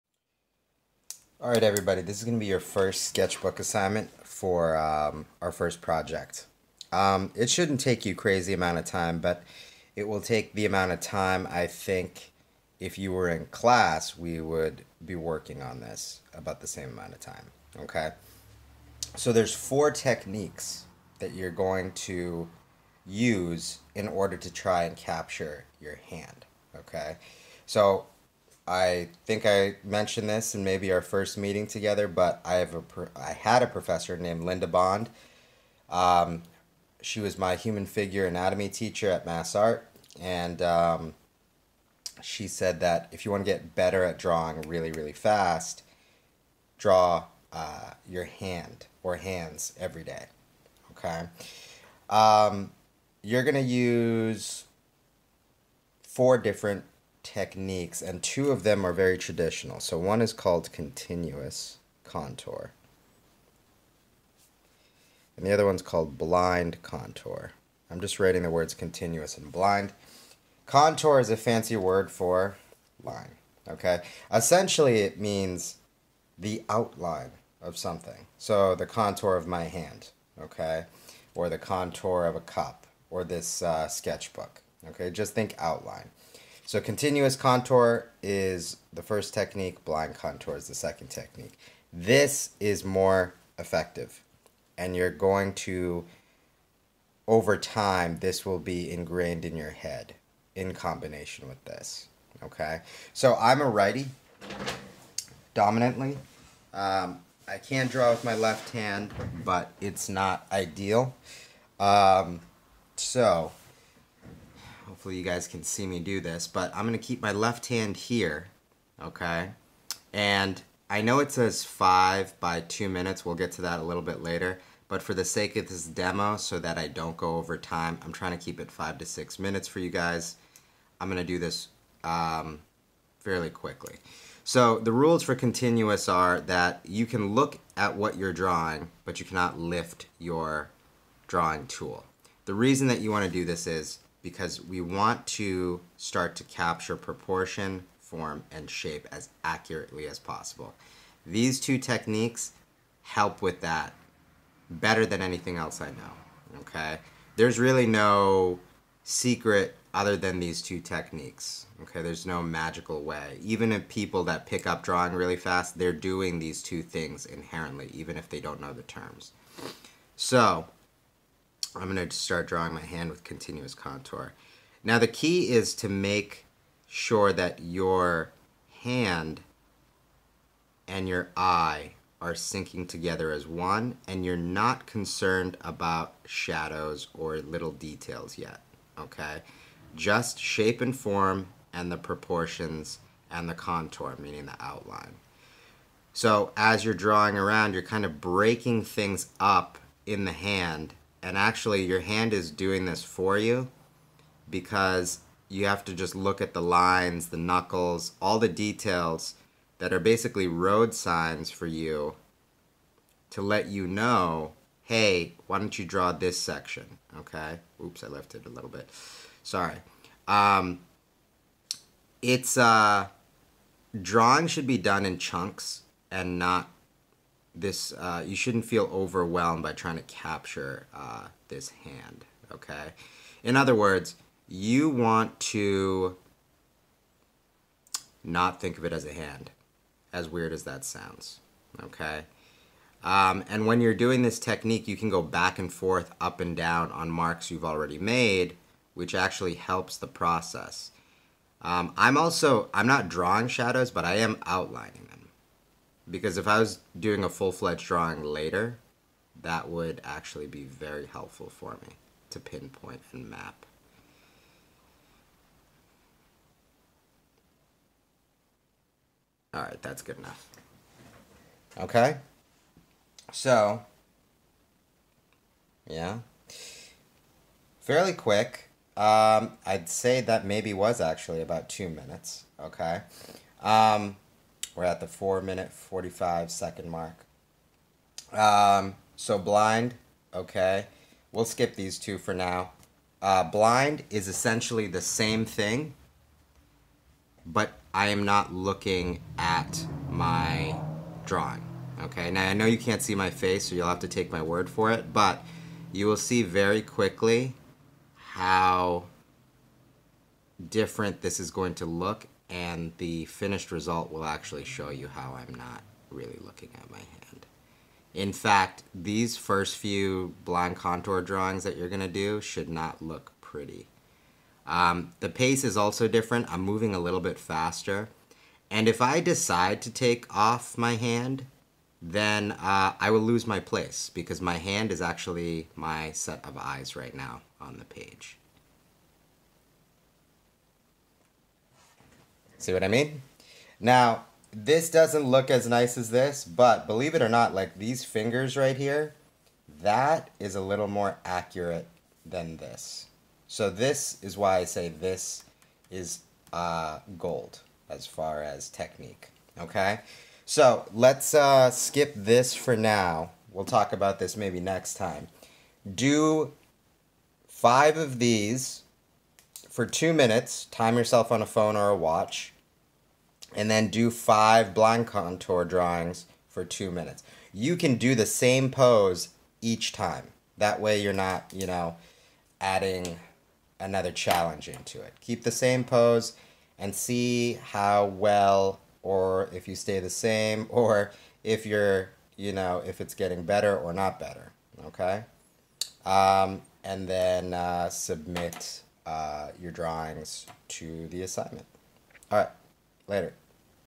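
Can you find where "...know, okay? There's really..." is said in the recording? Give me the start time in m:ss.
2:35.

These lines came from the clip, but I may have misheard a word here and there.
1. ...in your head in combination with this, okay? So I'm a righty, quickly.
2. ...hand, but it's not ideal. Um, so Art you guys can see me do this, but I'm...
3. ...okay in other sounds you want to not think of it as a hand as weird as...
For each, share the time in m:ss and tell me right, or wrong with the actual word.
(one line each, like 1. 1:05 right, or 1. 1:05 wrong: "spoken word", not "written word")
1. 1:39 wrong: "dominantly", not "quickly"
2. 1:48 wrong: "Hopefully", not "Art"
3. 3:52 wrong: "words", not "sounds".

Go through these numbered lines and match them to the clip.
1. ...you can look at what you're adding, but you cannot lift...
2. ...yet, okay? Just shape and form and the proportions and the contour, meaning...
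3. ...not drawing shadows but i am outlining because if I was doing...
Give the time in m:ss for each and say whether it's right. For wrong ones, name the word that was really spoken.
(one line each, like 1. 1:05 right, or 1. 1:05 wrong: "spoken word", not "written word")
1. 2:16 wrong: "drawing", not "adding"
2. 3:08 right
3. 4:12 right.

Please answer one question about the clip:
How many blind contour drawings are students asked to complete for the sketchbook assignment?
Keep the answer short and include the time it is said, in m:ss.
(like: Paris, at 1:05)
5, at 6:14.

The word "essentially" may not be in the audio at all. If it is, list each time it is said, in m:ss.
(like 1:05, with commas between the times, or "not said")
1:14, 4:54.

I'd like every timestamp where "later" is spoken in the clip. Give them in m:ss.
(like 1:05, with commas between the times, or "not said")
2:04, 4:18, 6:43.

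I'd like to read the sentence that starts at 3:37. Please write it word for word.
Oops, I left it a little bit.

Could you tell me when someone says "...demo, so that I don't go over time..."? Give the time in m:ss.
2:05.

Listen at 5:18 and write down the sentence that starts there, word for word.
In fact, these first few blind contour drawings that you're gonna do should not look pretty.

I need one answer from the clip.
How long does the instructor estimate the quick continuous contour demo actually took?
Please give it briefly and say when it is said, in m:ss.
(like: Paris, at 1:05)
2 minutes, at 4:41.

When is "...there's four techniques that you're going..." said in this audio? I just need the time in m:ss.
0:19.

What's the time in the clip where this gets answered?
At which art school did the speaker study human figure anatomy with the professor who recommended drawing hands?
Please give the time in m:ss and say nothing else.
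0:39.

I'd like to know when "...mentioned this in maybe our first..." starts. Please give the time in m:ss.
0:29.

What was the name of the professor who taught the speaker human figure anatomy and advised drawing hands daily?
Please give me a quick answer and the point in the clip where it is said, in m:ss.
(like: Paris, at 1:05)
Linda Bond, at 0:34.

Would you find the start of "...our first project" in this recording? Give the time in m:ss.
0:05.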